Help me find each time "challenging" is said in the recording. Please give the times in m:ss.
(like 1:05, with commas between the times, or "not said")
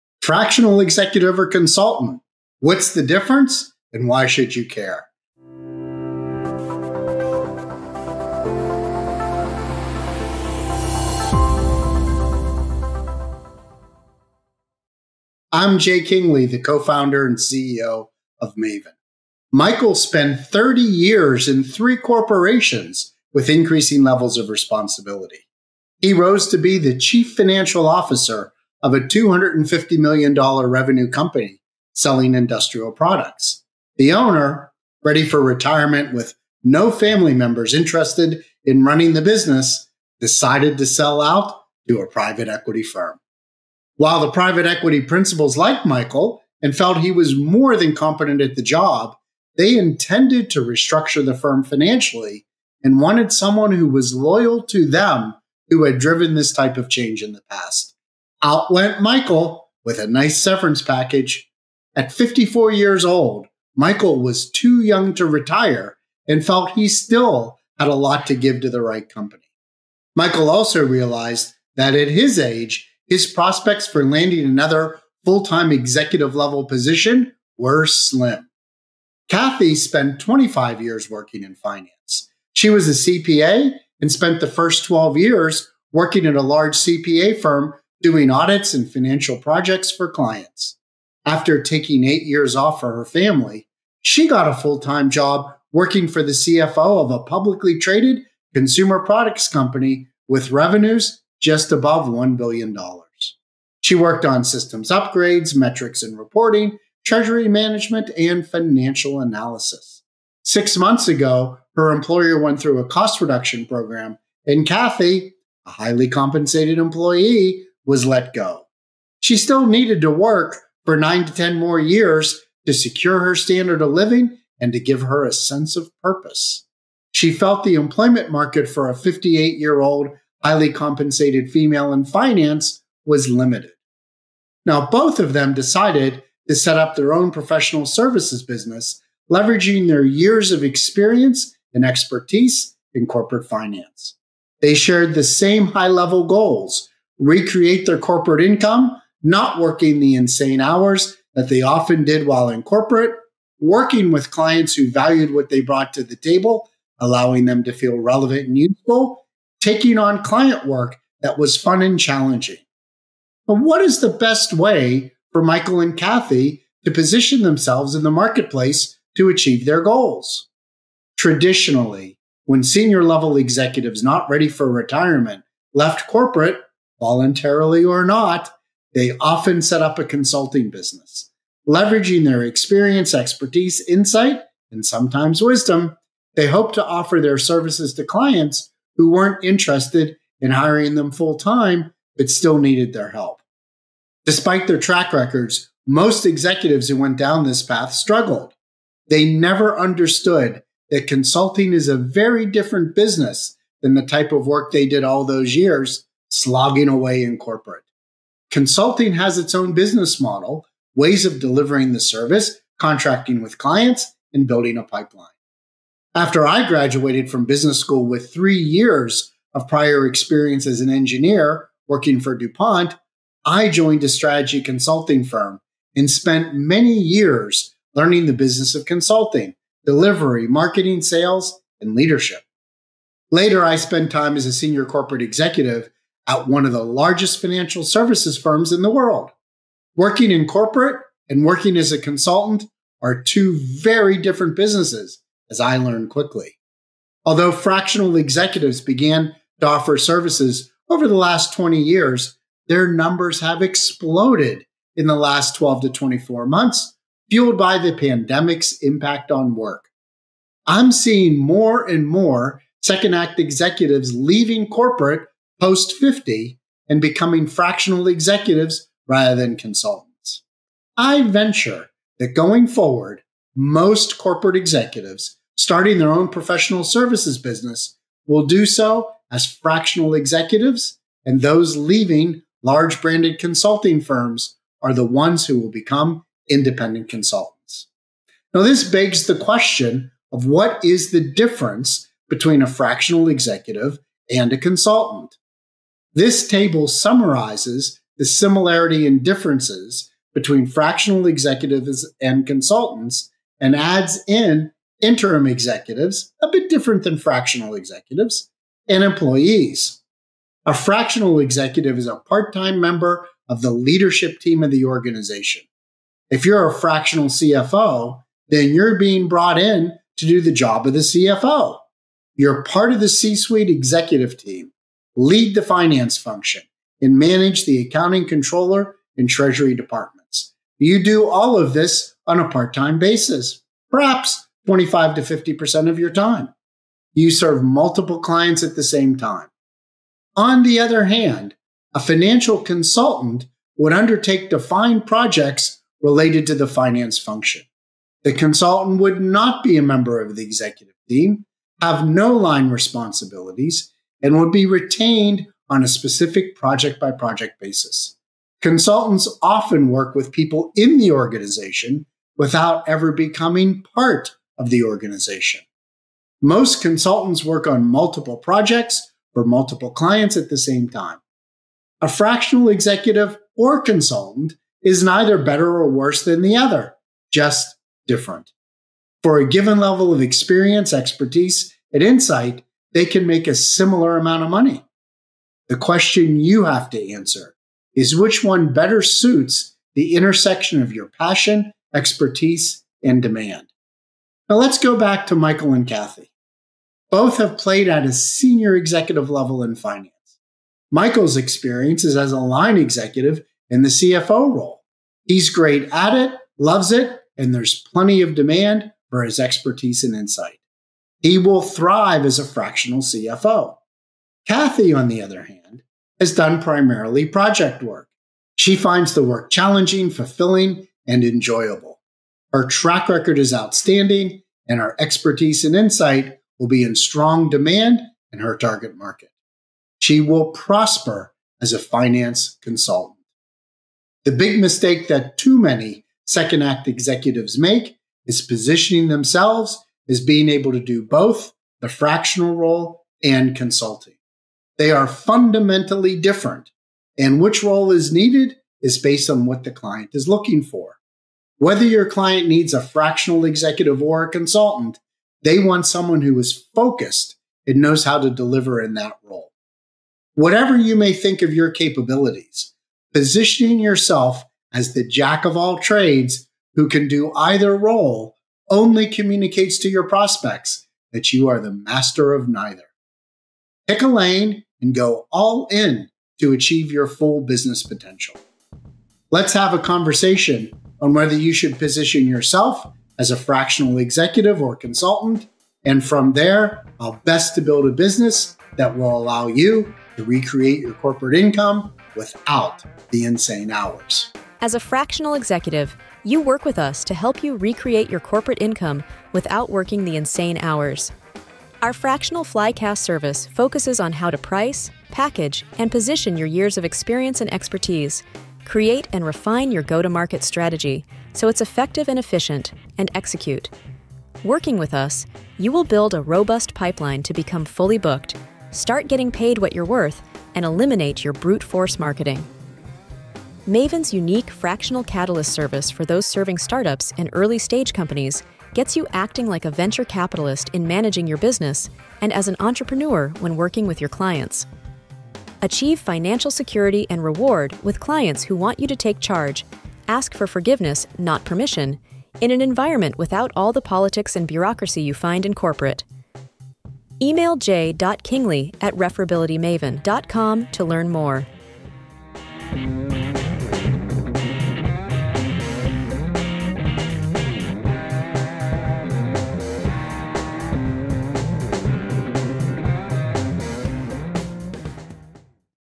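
2:41, 6:59.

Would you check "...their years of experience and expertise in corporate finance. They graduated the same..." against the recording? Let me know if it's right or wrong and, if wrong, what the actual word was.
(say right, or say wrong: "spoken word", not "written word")
wrong: "shared", not "graduated".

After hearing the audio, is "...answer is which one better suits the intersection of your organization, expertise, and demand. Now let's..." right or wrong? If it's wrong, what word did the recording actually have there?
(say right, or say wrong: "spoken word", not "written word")
wrong: "passion", not "organization".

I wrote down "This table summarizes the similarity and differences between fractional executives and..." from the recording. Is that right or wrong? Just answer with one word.
right.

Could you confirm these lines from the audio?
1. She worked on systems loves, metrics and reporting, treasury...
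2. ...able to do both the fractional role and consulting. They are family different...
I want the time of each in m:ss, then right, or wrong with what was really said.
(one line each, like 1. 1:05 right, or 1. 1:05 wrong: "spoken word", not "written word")
1. 1:43 wrong: "upgrades", not "loves"
2. 7:20 wrong: "fundamentally", not "family".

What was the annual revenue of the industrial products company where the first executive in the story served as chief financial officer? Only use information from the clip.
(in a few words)
$250 million.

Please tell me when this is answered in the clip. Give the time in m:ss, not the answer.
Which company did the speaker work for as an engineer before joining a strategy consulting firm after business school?
3:42.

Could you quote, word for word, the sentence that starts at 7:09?
She will prosper as a finance consultant.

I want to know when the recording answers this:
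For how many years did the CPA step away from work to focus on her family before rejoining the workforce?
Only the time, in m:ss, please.
1:32.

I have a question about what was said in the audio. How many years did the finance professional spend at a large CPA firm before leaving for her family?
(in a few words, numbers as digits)
12.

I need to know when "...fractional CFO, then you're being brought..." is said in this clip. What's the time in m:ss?
5:16.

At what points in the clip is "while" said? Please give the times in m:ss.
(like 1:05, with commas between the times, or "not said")
0:43, 2:32.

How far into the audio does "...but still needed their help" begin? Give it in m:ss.
3:12.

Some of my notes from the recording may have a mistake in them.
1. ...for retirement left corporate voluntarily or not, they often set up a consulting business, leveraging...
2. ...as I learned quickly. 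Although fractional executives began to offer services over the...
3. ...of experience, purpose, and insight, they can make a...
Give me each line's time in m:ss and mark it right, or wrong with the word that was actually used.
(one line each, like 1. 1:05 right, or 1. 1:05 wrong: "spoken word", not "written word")
1. 2:54 right
2. 4:05 right
3. 6:20 wrong: "expertise", not "purpose".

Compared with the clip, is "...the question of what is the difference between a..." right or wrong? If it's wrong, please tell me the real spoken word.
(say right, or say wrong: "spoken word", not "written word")
right.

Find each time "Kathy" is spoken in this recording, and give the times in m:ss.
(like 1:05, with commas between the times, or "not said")
1:19, 1:54, 2:45, 6:35, 6:54.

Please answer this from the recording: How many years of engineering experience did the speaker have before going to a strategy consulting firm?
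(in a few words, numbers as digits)
3.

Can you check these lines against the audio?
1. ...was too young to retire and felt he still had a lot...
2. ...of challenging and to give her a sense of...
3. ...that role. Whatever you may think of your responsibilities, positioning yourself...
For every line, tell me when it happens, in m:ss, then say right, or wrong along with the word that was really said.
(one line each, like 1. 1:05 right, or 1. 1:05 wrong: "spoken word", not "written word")
1. 1:04 right
2. 2:03 wrong: "living", not "challenging"
3. 7:38 wrong: "capabilities", not "responsibilities".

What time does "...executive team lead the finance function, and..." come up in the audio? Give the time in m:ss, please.
5:23.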